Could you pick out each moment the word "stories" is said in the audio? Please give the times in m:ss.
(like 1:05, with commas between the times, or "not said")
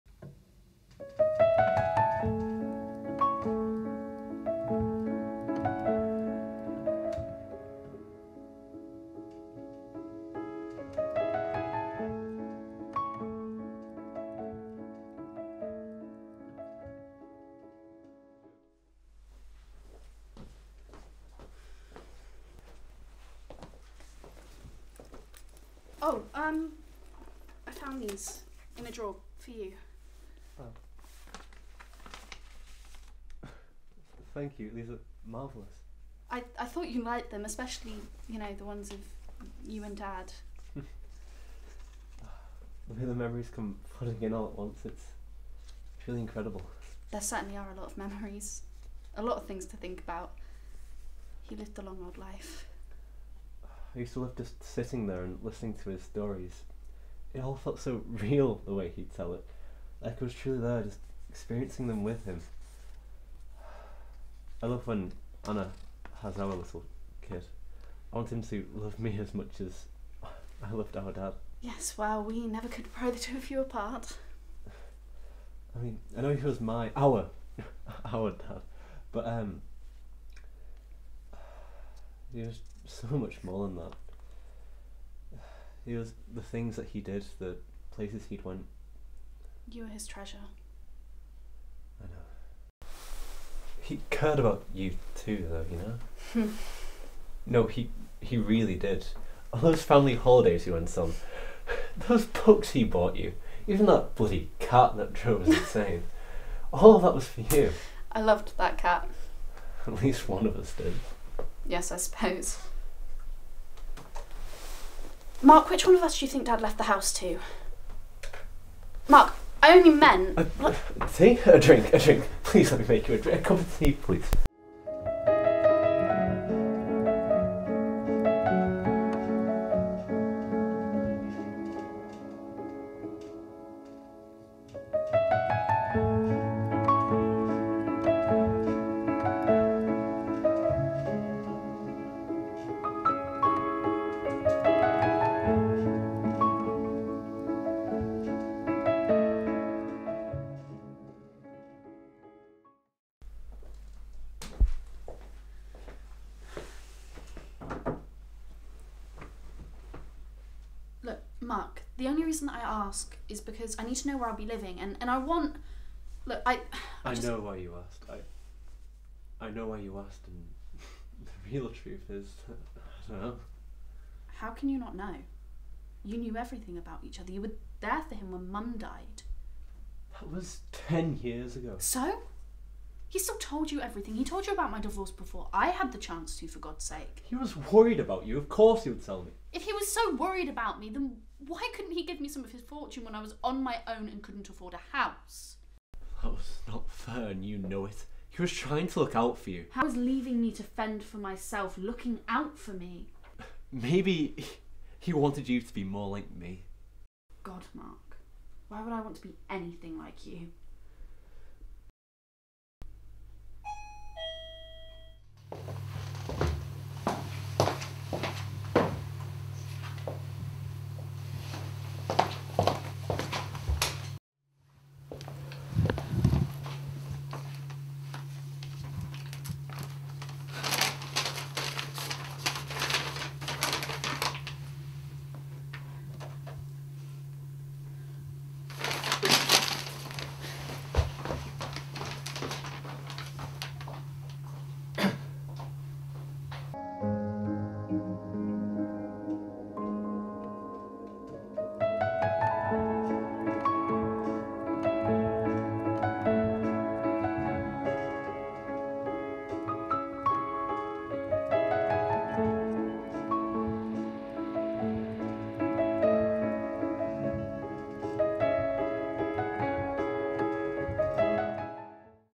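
0:56.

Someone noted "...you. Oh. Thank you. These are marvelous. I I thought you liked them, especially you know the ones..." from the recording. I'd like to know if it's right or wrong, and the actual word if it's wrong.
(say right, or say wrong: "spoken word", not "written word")
right.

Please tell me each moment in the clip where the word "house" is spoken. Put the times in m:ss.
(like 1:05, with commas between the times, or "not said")
1:56, 3:14.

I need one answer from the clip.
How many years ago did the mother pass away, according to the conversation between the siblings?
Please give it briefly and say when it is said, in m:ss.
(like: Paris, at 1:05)
10 years, at 3:00.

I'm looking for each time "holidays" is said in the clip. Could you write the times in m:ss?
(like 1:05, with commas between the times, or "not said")
1:40.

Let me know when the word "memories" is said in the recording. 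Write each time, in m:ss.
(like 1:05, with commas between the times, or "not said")
0:43, 0:47.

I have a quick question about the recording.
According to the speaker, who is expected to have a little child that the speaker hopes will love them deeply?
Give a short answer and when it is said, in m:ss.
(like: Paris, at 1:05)
Anna, at 1:05.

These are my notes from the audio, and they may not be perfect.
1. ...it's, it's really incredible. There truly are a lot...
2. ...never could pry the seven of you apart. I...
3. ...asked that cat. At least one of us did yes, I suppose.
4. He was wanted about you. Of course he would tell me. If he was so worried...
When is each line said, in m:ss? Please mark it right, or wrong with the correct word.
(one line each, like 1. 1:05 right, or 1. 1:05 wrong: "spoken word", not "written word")
1. 0:44 wrong: "certainly", not "truly"
2. 1:12 wrong: "two", not "seven"
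3. 1:48 wrong: "loved", not "asked"
4. 3:07 wrong: "worried", not "wanted".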